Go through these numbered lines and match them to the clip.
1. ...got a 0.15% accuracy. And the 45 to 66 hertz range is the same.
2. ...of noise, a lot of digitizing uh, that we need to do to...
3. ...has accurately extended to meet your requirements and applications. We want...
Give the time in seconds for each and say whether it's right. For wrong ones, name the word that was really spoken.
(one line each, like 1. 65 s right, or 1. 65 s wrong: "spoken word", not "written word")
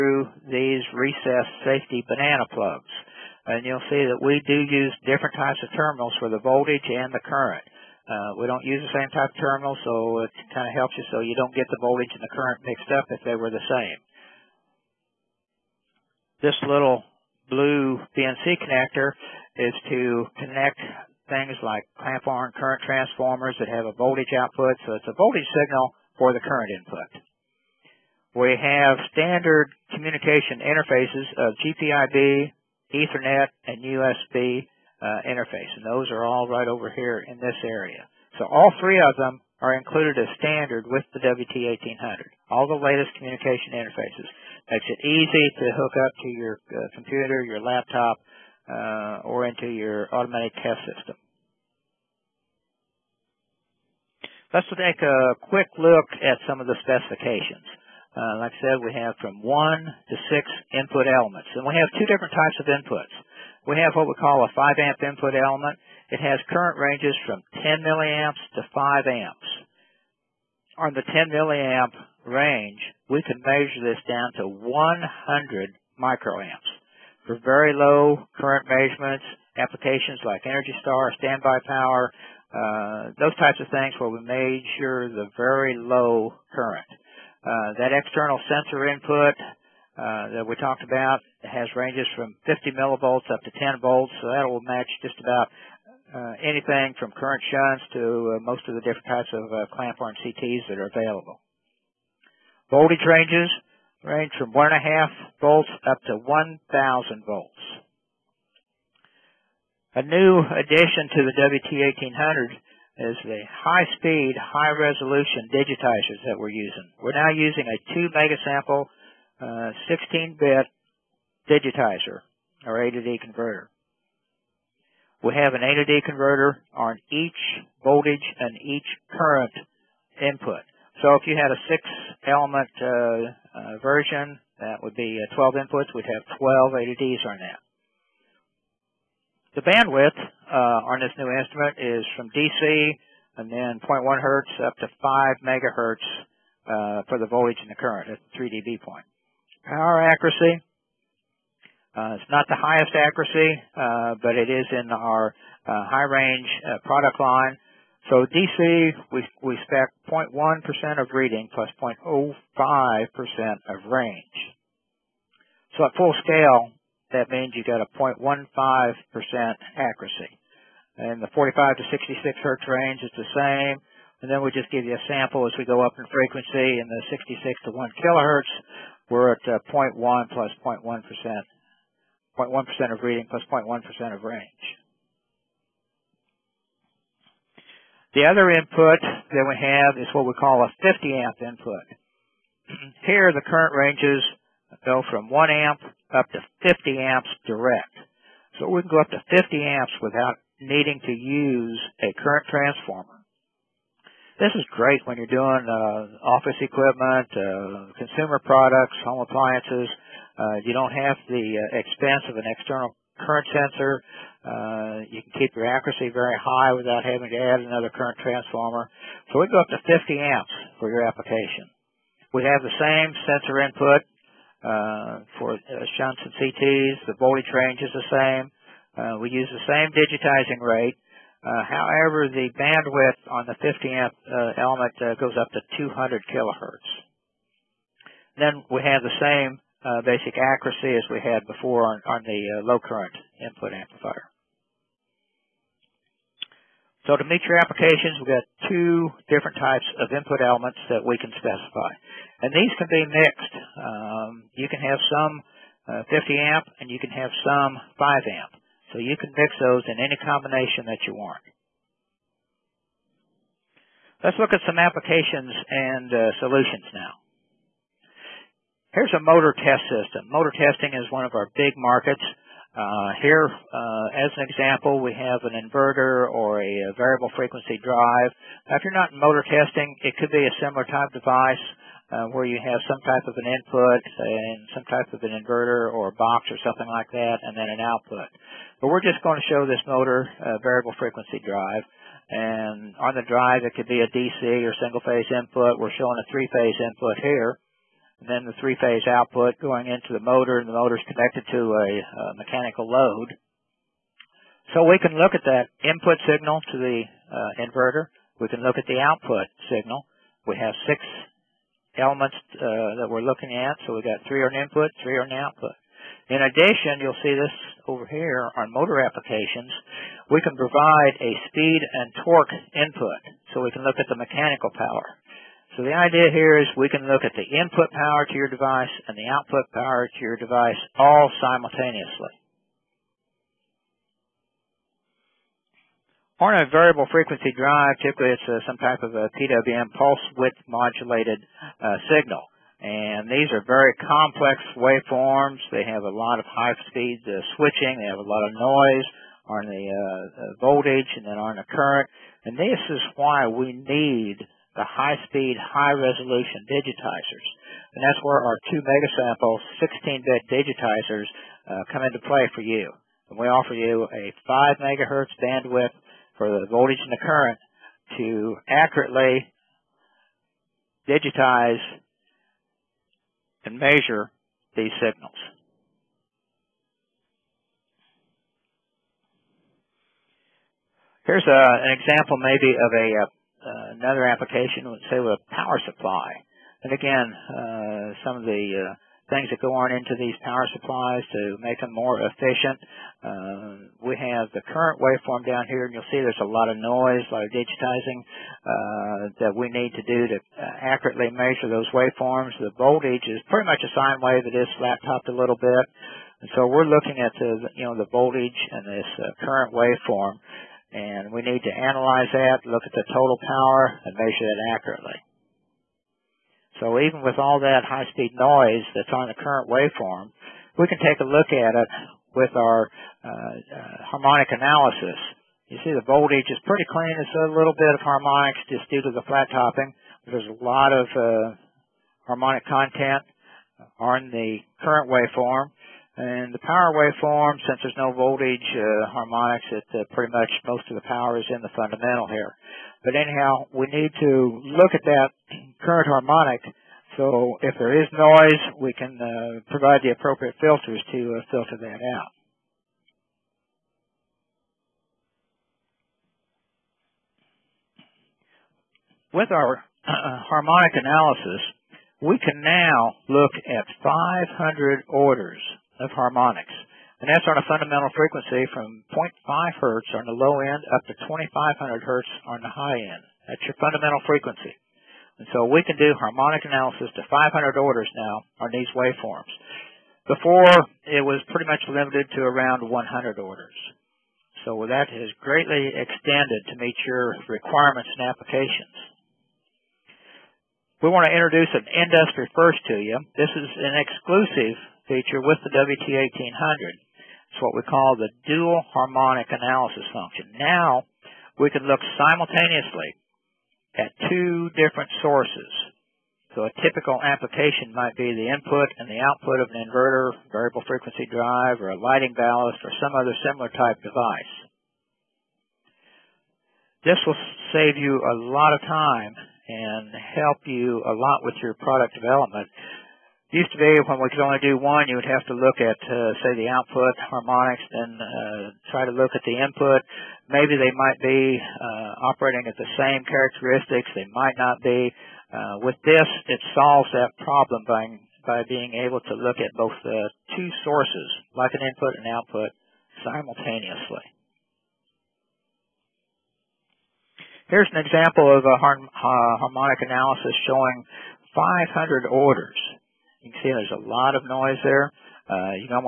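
1. 167 s right
2. 396 s right
3. 485 s wrong: "greatly", not "accurately".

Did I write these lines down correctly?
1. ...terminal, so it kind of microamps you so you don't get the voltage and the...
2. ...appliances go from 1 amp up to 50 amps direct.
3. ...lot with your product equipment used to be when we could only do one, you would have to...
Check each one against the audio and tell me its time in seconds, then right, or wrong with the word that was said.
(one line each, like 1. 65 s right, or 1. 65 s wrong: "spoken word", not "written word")
1. 9 s wrong: "helps", not "microamps"
2. 193 s wrong: "ranges", not "appliances"
3. 521 s wrong: "development", not "equipment".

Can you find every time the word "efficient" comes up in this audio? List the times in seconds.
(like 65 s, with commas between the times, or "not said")
392 s.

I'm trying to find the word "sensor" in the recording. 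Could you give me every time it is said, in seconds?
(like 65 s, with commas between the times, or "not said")
88 s, 213 s, 223 s.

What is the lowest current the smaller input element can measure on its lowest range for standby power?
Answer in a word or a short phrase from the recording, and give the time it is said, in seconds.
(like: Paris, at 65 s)
100 microamps, at 74 s.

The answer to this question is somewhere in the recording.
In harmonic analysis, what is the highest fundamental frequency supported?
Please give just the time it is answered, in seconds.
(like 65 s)
471 s.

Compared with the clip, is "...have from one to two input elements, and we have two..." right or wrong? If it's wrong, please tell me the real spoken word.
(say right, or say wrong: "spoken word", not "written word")
wrong: "six", not "two".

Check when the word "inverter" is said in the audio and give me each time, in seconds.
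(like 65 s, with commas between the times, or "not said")
275 s, 285 s, 307 s, 509 s.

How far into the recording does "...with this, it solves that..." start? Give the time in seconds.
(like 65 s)
535 s.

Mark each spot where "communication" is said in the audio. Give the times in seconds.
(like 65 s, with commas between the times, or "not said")
29 s, 43 s.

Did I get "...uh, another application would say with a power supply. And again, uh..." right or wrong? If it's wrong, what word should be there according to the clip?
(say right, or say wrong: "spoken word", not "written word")
right.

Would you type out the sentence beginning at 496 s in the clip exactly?
It's what we call the dual harmonic analysis function.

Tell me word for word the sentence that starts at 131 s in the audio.
So if you had a six-element uh, uh, version, that would be uh, 12 inputs.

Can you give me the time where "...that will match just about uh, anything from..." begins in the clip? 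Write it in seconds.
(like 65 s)
94 s.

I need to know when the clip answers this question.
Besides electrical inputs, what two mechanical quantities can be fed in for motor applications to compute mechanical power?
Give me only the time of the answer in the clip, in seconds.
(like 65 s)
321 s.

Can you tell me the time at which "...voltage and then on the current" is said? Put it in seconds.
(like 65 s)
350 s.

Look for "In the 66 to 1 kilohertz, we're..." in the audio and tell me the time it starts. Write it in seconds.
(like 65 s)
176 s.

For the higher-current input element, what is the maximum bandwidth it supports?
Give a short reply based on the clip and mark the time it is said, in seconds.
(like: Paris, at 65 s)
200 kilohertz, at 235 s.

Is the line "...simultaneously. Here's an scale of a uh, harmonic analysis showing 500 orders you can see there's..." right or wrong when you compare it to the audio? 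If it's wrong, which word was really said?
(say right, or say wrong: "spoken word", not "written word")
wrong: "example", not "scale".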